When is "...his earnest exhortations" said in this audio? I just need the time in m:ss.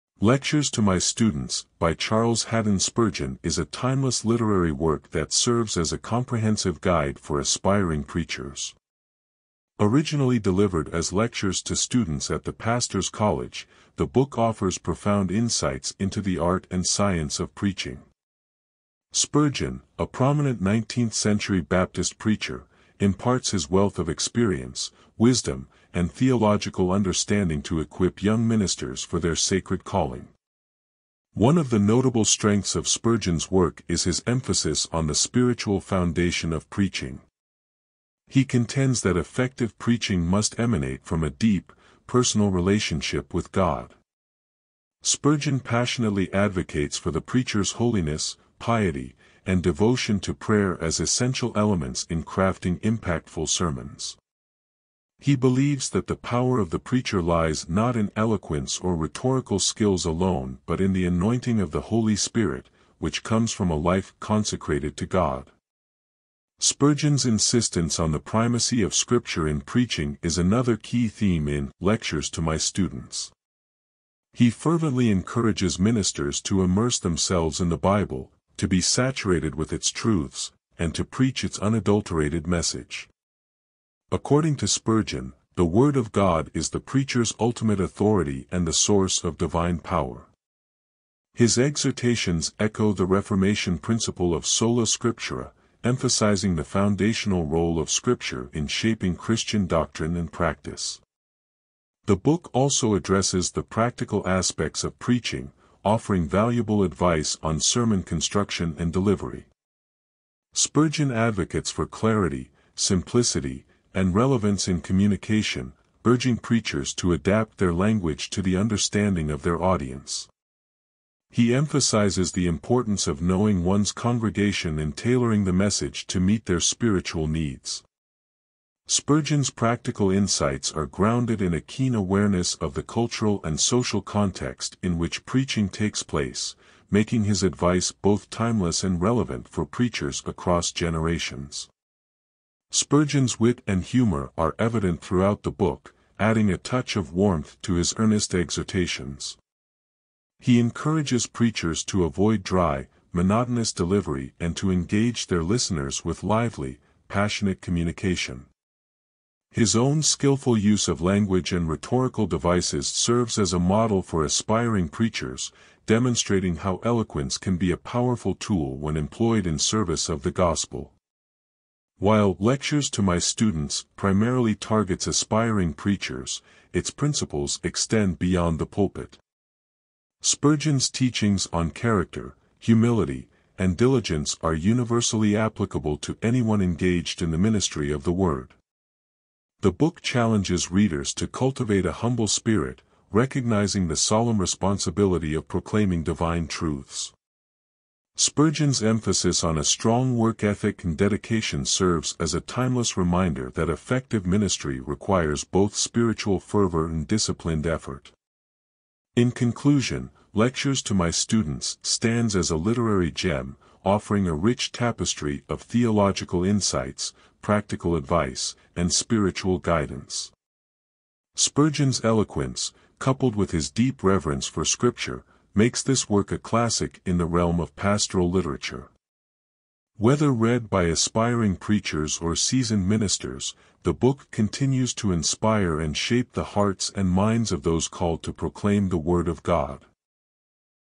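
2:27.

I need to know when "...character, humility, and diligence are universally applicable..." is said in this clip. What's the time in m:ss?
3:01.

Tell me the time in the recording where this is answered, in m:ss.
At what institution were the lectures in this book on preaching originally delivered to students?
0:12.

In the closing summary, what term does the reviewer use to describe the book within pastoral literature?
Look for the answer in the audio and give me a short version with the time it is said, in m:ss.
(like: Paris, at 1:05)
a literary gem, at 3:32.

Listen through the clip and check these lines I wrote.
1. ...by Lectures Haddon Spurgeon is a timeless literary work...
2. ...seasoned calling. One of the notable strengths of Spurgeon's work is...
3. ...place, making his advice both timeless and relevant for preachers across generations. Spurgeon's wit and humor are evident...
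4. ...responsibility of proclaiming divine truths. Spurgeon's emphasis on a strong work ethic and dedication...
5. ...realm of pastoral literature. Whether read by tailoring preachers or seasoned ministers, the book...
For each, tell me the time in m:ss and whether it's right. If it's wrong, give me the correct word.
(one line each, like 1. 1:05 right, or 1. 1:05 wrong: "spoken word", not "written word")
1. 0:01 wrong: "Charles", not "Lectures"
2. 0:29 wrong: "sacred", not "seasoned"
3. 2:16 right
4. 3:14 right
5. 3:47 wrong: "aspiring", not "tailoring".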